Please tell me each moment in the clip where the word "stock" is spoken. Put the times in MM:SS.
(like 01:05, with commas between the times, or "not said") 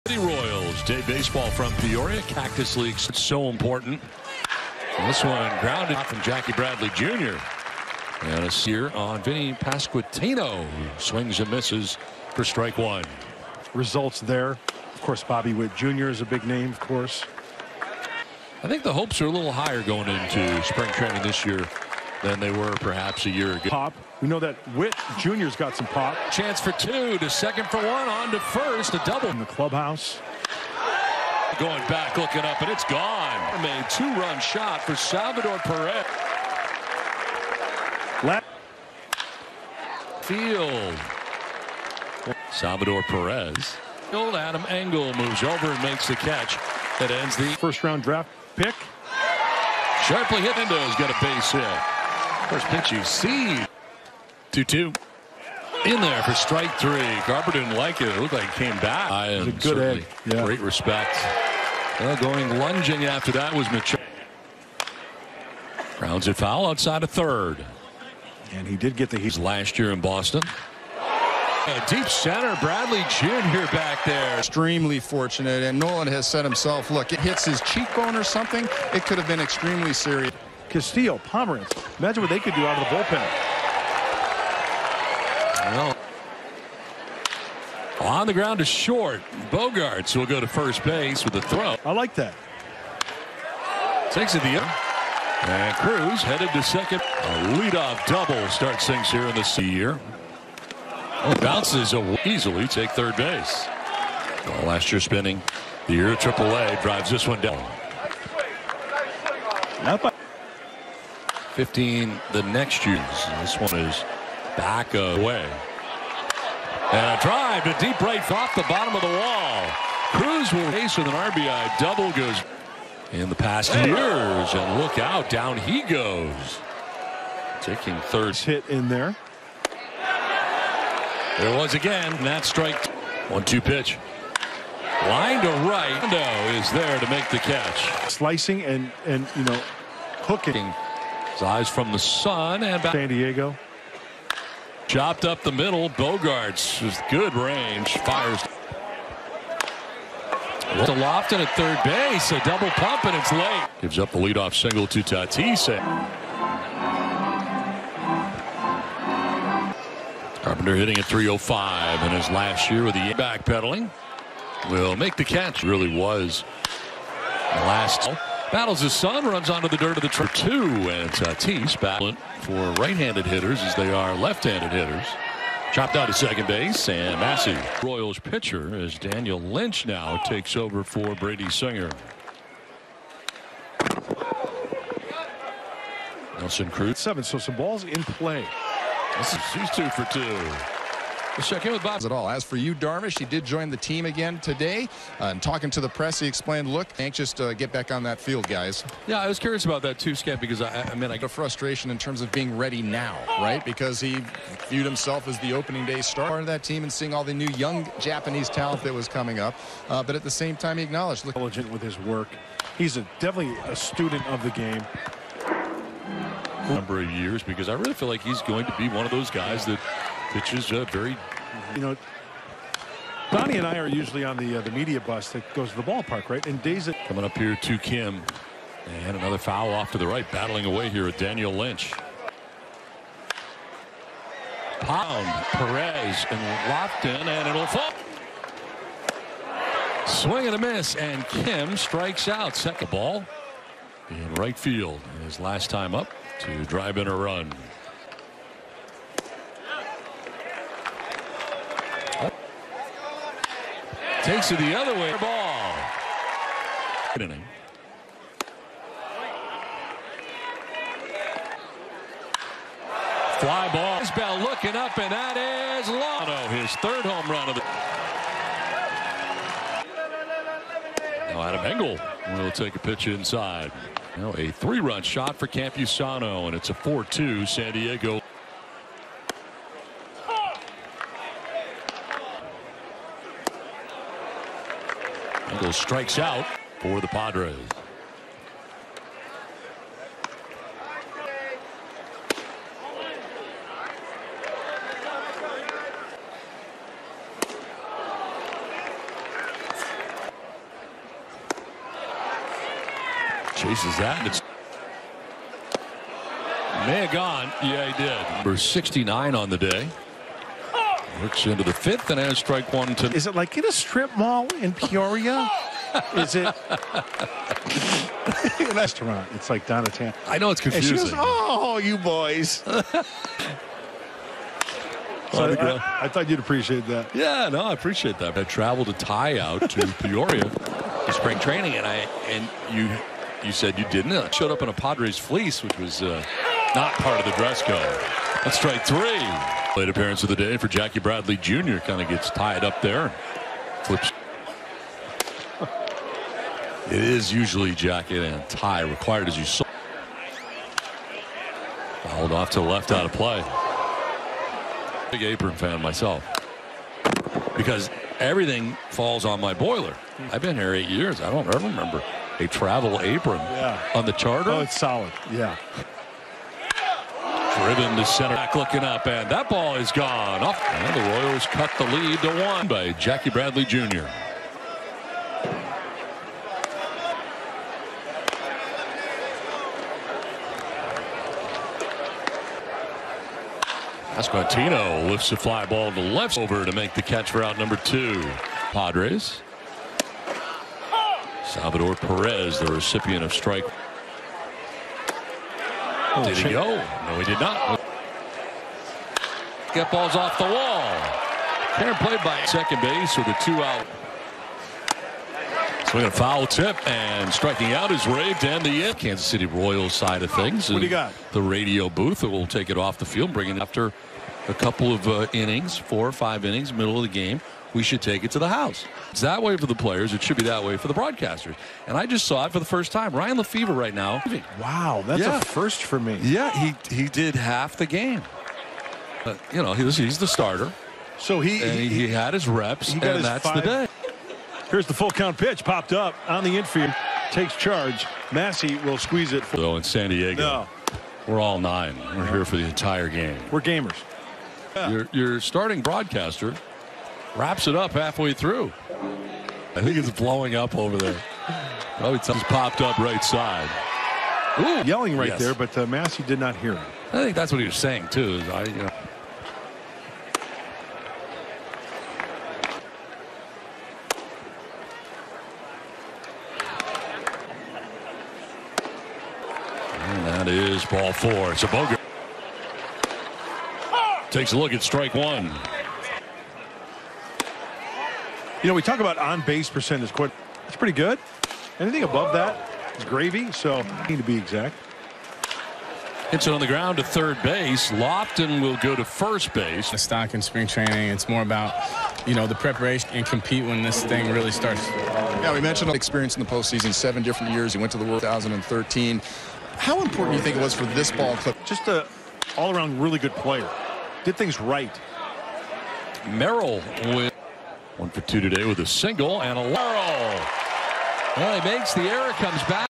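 08:09.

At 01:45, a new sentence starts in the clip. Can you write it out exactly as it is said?
The year AAA drives this one down.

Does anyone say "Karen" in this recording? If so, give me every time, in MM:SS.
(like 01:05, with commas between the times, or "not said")
06:41.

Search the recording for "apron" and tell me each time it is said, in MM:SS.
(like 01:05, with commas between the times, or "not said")
05:55, 06:03.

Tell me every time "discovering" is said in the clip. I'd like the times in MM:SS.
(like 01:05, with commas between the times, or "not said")
not said.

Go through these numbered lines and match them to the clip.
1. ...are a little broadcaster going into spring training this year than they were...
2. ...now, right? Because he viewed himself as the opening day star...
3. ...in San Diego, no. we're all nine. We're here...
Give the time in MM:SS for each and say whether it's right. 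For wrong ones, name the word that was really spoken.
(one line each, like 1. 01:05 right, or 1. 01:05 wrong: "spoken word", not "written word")
1. 00:19 wrong: "higher", not "broadcaster"
2. 03:22 right
3. 07:19 right.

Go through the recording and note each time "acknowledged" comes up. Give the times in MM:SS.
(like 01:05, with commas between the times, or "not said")
03:30.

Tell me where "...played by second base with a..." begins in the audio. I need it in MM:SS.
06:41.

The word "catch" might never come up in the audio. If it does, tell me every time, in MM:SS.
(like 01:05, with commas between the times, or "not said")
00:46, 02:17, 02:45, 06:27.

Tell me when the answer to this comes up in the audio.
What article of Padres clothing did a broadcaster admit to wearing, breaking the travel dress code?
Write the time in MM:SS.
05:34.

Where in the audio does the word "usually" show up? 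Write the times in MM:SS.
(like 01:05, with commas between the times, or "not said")
03:43, 05:47.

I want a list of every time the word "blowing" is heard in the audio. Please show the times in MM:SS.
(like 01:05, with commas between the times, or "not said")
07:30.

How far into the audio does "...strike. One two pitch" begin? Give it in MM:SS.
02:12.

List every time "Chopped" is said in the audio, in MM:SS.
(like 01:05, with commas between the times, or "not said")
02:24, 02:55.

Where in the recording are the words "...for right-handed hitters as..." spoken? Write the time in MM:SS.
02:52.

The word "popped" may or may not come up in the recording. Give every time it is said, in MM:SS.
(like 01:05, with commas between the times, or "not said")
07:15, 07:32.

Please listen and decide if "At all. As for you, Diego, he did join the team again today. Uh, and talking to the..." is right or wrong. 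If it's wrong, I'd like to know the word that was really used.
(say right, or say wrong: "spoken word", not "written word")
wrong: "Darvish", not "Diego".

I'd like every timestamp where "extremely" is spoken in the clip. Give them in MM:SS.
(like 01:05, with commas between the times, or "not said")
01:14, 01:19.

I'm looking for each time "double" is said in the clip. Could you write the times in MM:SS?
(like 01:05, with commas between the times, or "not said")
00:29, 01:38, 02:01, 02:32.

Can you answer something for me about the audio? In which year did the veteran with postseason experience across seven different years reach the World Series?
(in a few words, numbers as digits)
2013.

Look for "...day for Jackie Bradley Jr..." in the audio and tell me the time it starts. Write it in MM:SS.
05:40.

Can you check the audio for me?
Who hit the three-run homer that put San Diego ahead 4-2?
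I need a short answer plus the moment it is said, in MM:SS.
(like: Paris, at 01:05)
Campusano, at 04:34.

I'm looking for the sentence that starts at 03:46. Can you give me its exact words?
And days coming up here to Kim, and another foul off to the right, battling away here at Daniel Lynch.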